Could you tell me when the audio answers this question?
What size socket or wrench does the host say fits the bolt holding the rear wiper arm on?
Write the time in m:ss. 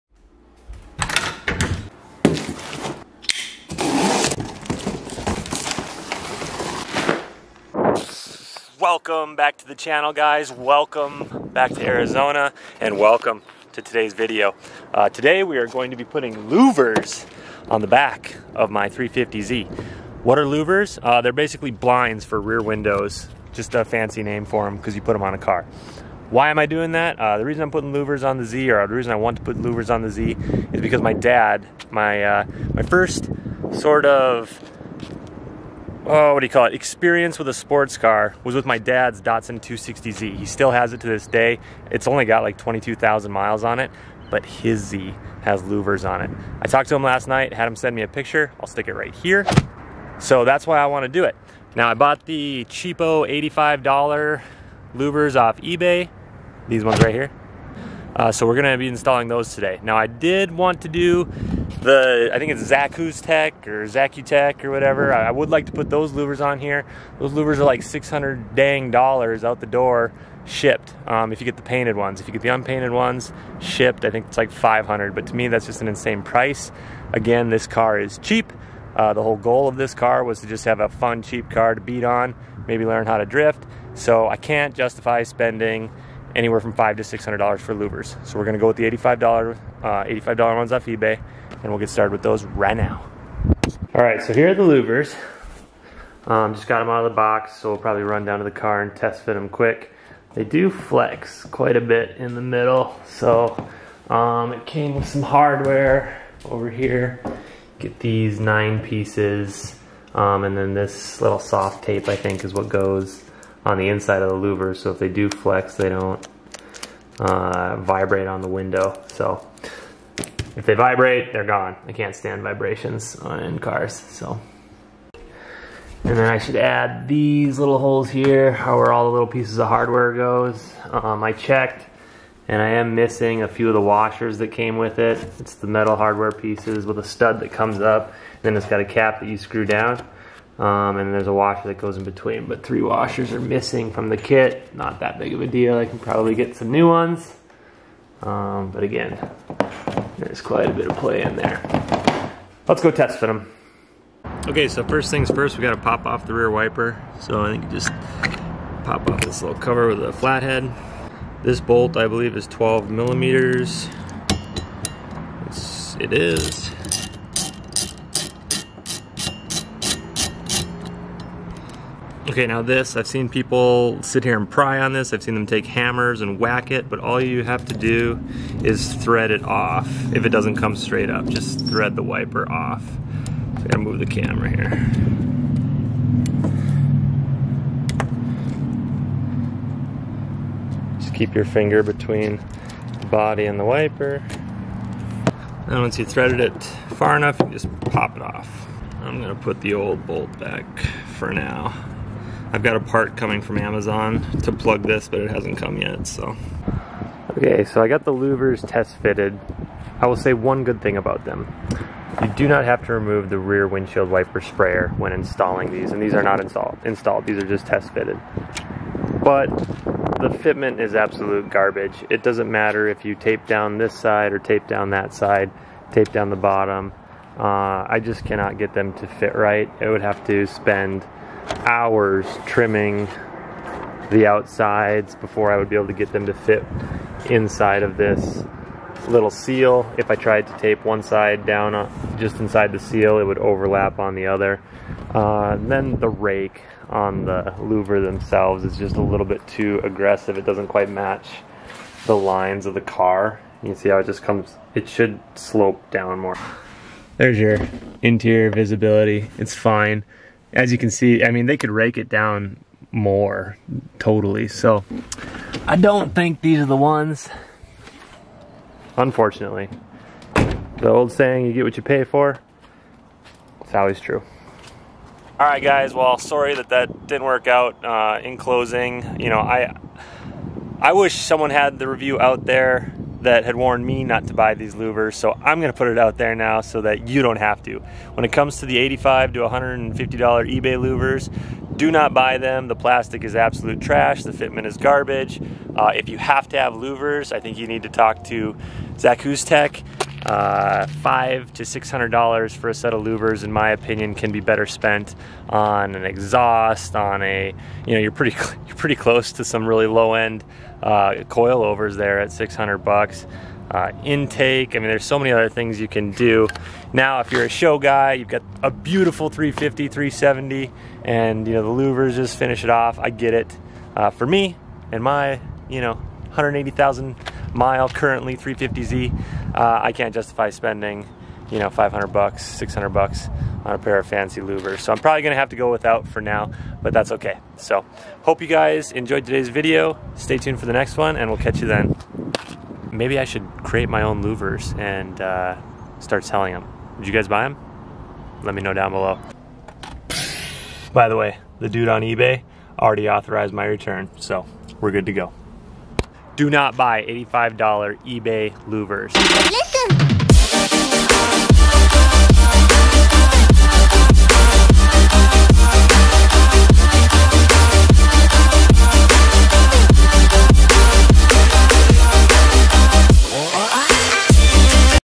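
2:42.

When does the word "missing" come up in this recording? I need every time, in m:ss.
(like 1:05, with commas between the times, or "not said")
2:12, 2:23.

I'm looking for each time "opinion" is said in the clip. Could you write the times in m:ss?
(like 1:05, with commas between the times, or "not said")
5:03.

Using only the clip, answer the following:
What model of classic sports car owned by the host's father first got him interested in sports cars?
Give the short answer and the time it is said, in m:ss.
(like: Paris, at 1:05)
Datsun 260Z, at 0:39.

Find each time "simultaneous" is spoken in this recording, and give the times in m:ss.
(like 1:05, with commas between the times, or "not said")
not said.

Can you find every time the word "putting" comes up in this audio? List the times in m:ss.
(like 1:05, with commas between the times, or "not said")
0:16, 0:27.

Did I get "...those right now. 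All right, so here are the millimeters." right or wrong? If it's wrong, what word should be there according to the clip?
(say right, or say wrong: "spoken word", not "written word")
wrong: "louvers", not "millimeters".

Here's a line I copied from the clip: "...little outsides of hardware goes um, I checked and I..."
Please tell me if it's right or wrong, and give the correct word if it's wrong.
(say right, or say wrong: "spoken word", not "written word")
wrong: "pieces", not "outsides".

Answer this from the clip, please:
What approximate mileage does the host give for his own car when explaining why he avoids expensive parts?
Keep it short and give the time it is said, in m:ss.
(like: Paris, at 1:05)
180,000, at 5:25.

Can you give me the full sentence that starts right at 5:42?
Maybe I should create my own louvers and uh, start selling them.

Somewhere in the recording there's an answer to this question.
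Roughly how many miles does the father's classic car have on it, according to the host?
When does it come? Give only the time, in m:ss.
0:42.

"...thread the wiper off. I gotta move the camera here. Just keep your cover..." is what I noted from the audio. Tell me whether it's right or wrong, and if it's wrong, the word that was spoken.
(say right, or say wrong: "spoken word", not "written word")
wrong: "finger", not "cover".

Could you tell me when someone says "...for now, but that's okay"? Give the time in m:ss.
5:36.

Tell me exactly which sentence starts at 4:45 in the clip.
So I'm going to put it out there now so that you don't have to.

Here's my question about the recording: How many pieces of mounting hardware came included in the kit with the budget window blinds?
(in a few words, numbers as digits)
9.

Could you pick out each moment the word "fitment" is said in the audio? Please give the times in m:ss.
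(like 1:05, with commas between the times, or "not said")
3:40, 4:54.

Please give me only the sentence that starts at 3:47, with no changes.
Uh, I just cannot get them to fit right.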